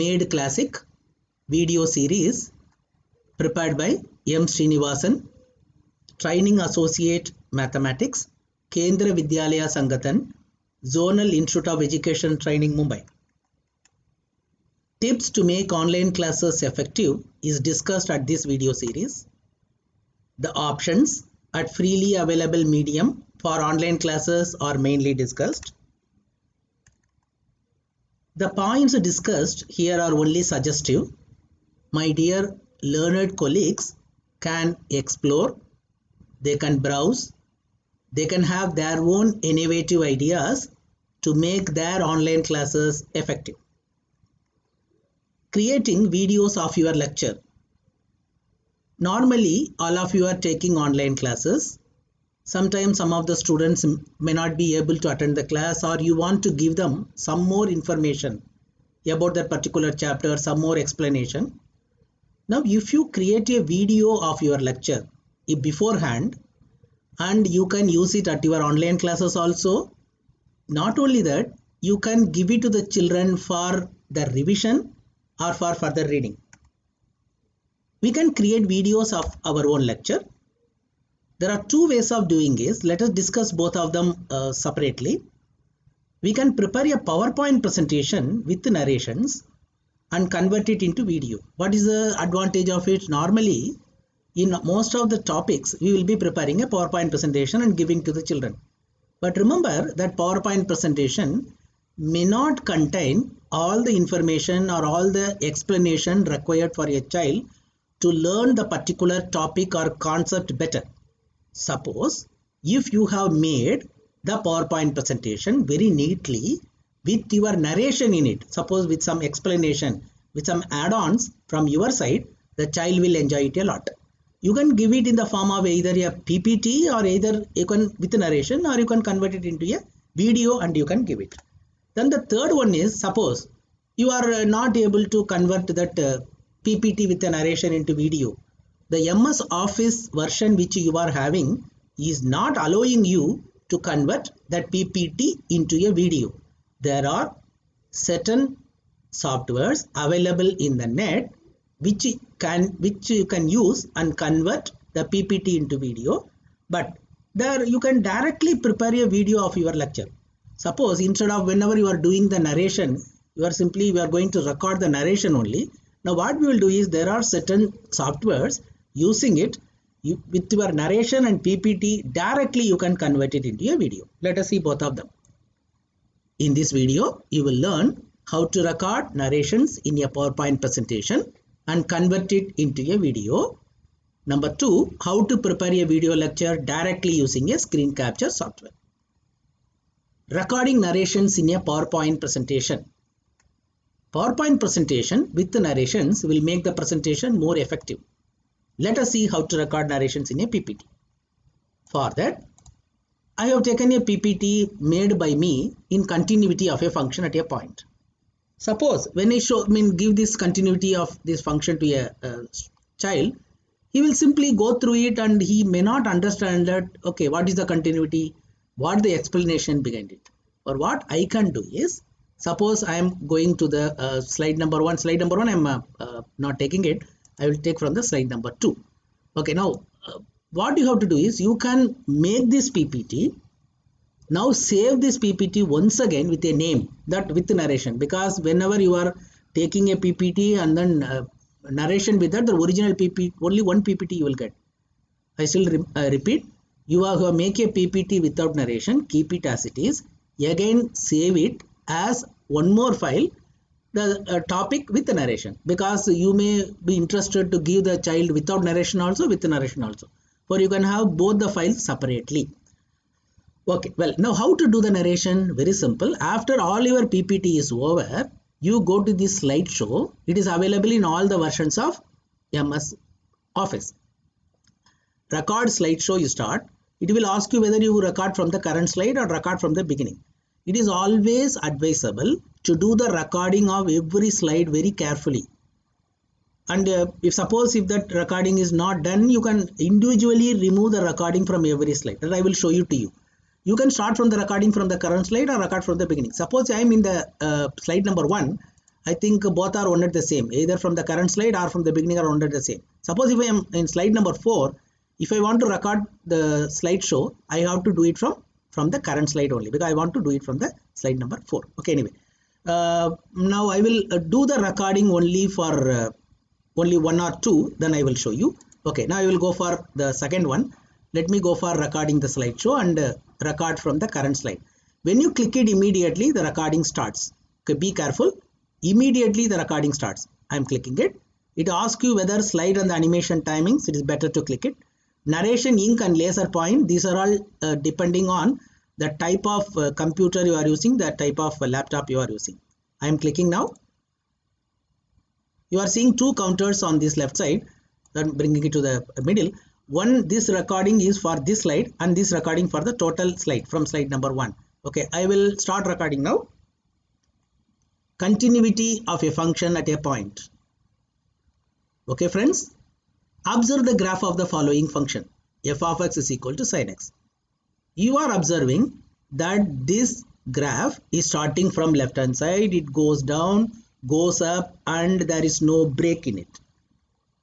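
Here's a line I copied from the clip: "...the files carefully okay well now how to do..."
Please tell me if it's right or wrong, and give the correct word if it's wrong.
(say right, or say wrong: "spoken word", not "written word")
wrong: "separately", not "carefully".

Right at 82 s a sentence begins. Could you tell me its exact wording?
Let us discuss both of them uh, separately.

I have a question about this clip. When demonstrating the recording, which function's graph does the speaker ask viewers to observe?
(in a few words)
sine x.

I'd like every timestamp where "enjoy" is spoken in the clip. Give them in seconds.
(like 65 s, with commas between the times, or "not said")
123 s.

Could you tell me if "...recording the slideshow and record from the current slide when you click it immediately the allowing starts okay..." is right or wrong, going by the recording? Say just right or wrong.
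wrong.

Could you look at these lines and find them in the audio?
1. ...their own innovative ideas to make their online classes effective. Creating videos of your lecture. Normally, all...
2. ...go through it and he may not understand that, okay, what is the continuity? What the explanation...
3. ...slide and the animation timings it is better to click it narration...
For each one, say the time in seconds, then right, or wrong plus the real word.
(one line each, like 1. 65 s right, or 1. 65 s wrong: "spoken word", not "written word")
1. 38 s right
2. 214 s right
3. 332 s right.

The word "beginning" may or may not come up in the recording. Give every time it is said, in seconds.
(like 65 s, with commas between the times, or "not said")
279 s, 296 s, 301 s.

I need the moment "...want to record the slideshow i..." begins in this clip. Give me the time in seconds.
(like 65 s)
305 s.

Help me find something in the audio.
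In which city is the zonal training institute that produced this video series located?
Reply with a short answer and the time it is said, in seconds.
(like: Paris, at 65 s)
Mumbai, at 12 s.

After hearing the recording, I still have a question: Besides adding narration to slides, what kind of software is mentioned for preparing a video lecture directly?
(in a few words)
screen capture software.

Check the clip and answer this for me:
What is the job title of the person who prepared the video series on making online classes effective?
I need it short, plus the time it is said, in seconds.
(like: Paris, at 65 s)
Training Associate Mathematics, at 6 s.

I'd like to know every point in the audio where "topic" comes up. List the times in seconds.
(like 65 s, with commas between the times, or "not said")
95 s, 109 s, 254 s.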